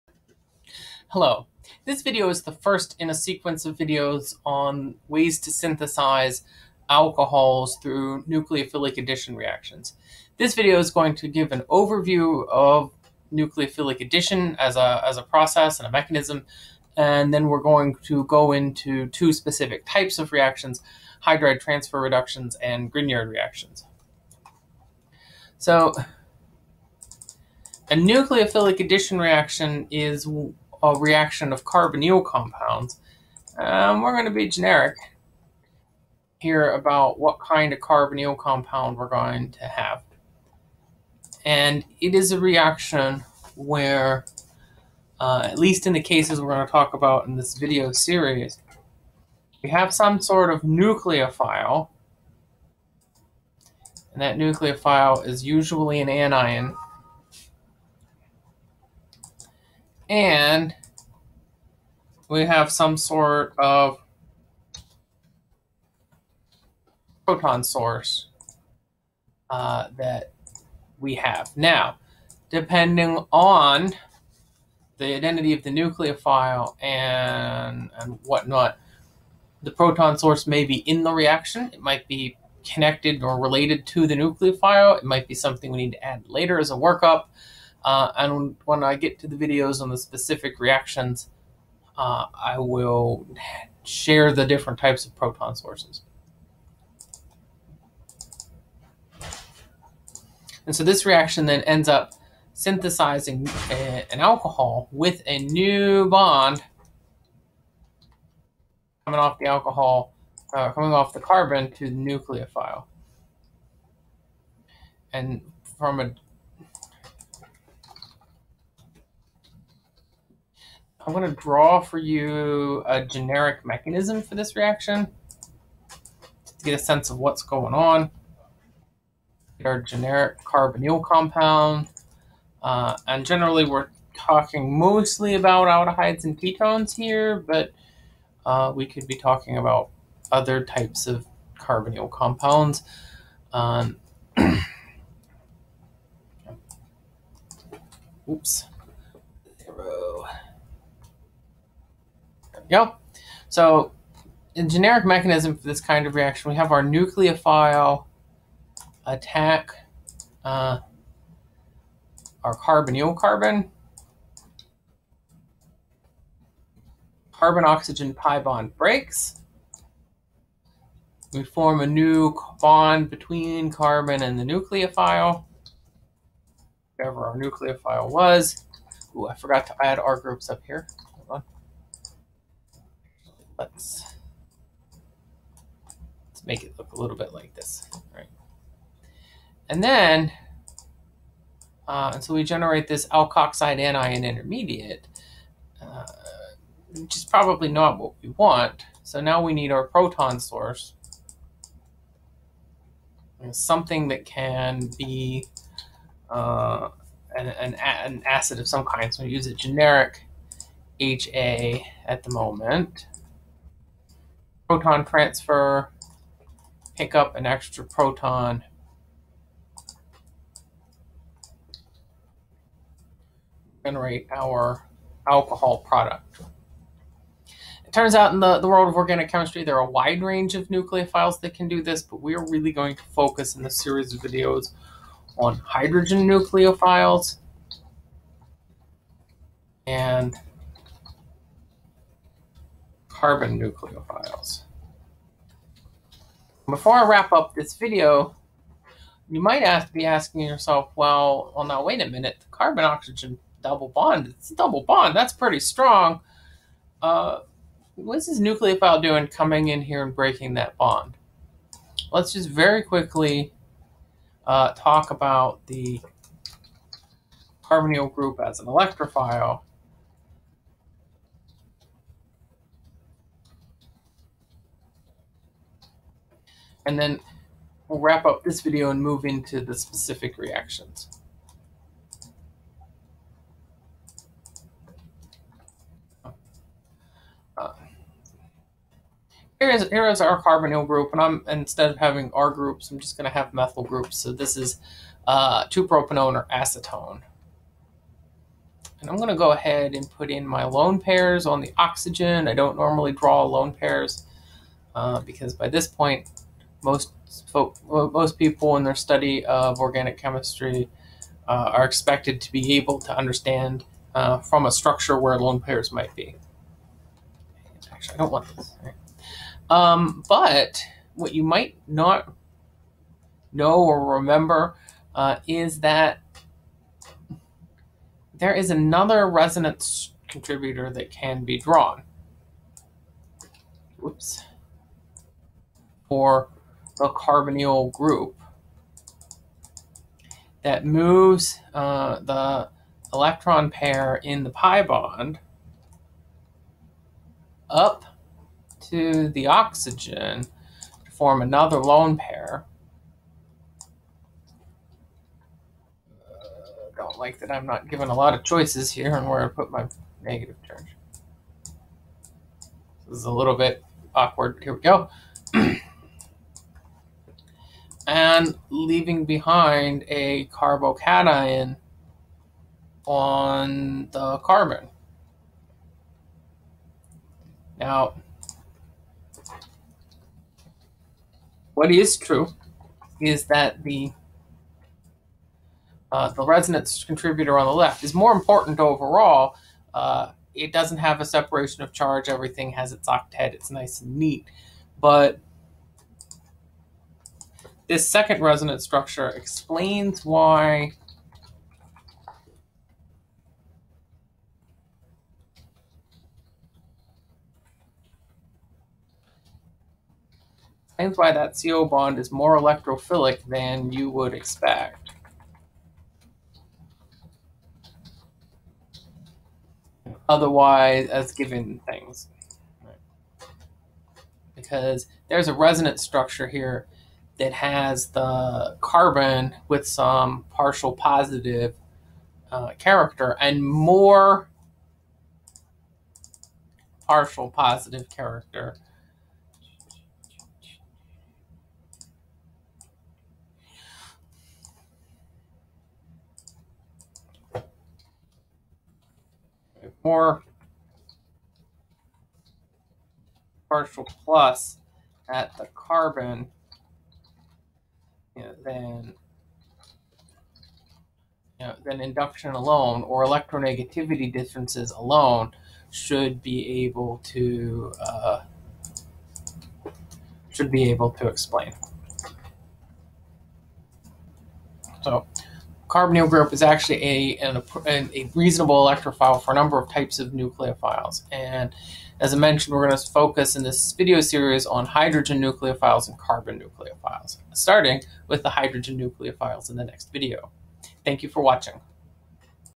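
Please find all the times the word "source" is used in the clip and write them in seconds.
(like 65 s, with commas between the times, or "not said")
67 s, 80 s, 95 s, 200 s.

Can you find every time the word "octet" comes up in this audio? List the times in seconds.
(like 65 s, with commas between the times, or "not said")
393 s.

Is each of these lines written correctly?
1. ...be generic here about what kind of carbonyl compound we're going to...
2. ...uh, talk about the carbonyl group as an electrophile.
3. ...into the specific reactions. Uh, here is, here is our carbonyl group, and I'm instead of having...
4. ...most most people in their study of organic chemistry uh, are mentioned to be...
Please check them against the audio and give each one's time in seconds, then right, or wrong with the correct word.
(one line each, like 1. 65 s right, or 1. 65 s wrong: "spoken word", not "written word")
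1. 34 s right
2. 264 s right
3. 279 s right
4. 306 s wrong: "expected", not "mentioned".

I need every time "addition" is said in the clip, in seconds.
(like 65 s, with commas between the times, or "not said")
8 s, 13 s, 28 s.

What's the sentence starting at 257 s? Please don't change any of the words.
Uh, what's this nucleophile doing coming in here and breaking that bond?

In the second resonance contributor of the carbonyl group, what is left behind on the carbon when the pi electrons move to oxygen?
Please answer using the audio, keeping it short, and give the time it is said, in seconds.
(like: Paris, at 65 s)
A carbocation, at 370 s.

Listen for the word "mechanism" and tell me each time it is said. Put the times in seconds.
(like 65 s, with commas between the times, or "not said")
15 s, 123 s, 155 s.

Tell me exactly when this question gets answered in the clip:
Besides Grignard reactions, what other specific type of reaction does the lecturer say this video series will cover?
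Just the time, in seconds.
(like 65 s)
21 s.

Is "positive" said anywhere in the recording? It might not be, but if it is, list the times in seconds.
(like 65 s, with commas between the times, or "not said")
430 s, 437 s.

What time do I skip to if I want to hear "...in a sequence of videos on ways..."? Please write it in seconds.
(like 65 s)
2 s.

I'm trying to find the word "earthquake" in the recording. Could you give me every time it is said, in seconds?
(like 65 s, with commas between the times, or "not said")
not said.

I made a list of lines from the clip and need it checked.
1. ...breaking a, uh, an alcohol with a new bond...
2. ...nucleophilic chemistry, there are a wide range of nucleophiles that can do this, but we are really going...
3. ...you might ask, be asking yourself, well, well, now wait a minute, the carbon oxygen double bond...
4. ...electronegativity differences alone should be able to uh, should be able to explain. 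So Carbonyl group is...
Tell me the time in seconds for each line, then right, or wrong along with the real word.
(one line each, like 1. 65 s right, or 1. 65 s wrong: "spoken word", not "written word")
1. 102 s wrong: "synthesizing", not "breaking"
2. 228 s wrong: "organic", not "nucleophilic"
3. 249 s right
4. 463 s right.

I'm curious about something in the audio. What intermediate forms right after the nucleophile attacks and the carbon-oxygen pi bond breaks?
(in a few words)
Alkoxide anion.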